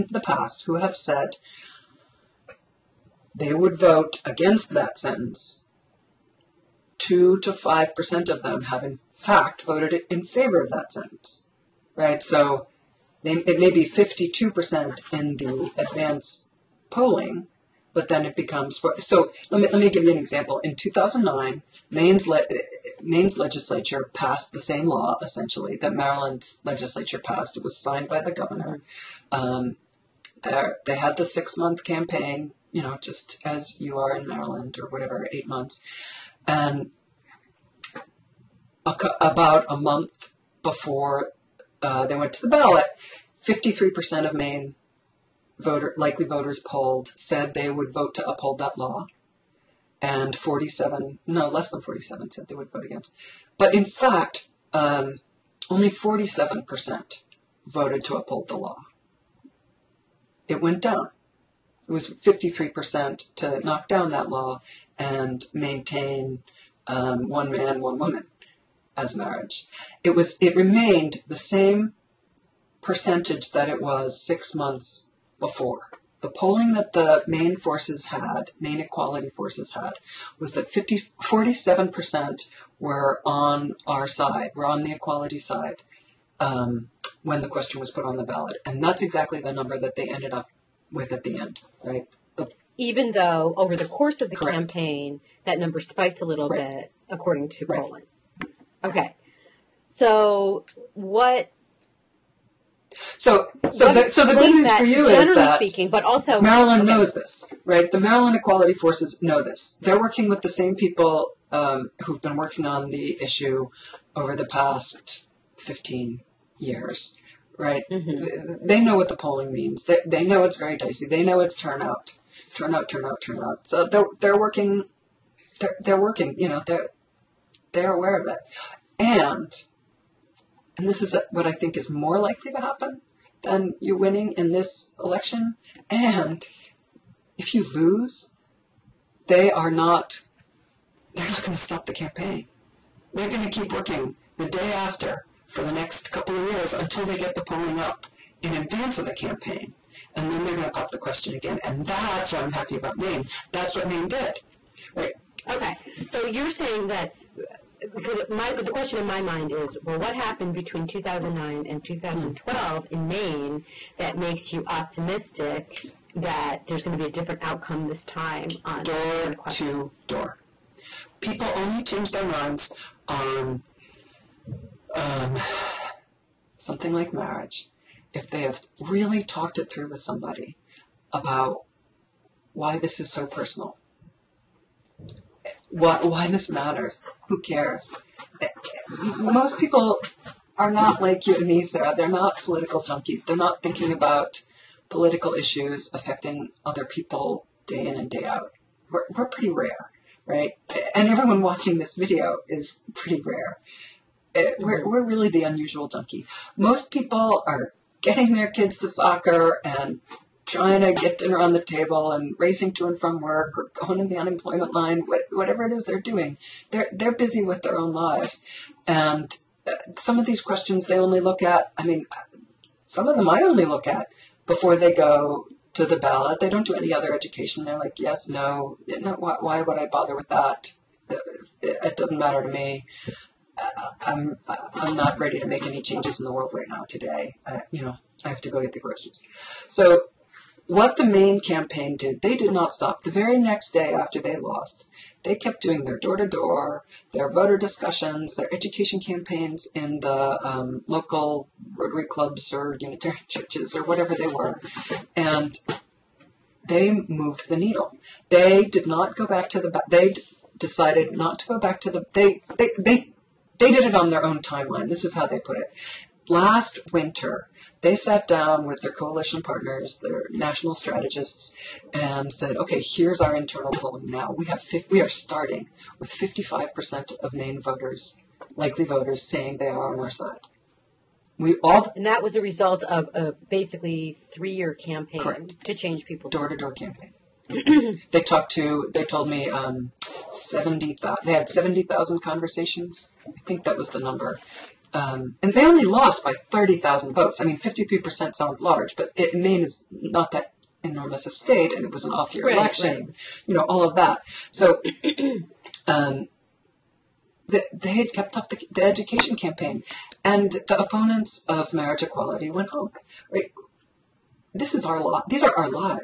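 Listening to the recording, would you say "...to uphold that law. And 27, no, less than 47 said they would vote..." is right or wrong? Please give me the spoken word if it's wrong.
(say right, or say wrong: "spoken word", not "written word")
wrong: "47", not "27".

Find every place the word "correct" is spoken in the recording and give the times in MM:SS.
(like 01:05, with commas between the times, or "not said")
01:34, 04:45.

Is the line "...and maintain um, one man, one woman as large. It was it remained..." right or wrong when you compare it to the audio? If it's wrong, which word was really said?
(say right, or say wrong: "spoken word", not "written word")
wrong: "marriage", not "large".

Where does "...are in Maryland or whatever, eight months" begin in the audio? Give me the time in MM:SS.
00:33.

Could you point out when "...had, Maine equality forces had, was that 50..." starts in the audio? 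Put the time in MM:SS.
01:18.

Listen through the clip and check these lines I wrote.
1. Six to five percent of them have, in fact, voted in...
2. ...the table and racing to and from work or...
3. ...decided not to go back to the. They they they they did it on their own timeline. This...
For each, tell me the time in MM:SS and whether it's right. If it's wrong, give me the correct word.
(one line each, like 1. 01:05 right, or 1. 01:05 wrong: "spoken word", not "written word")
1. 00:06 wrong: "Two", not "Six"
2. 03:31 right
3. 04:20 right.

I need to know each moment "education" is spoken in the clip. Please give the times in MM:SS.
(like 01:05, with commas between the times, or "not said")
03:47, 04:08, 05:08.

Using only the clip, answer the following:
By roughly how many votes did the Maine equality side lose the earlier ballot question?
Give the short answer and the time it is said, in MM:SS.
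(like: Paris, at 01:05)
30,000, at 04:56.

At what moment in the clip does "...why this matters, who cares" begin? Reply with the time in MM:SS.
03:06.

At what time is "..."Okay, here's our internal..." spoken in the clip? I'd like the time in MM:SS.
04:32.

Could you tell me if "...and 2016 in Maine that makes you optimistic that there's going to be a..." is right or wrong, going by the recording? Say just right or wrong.
wrong.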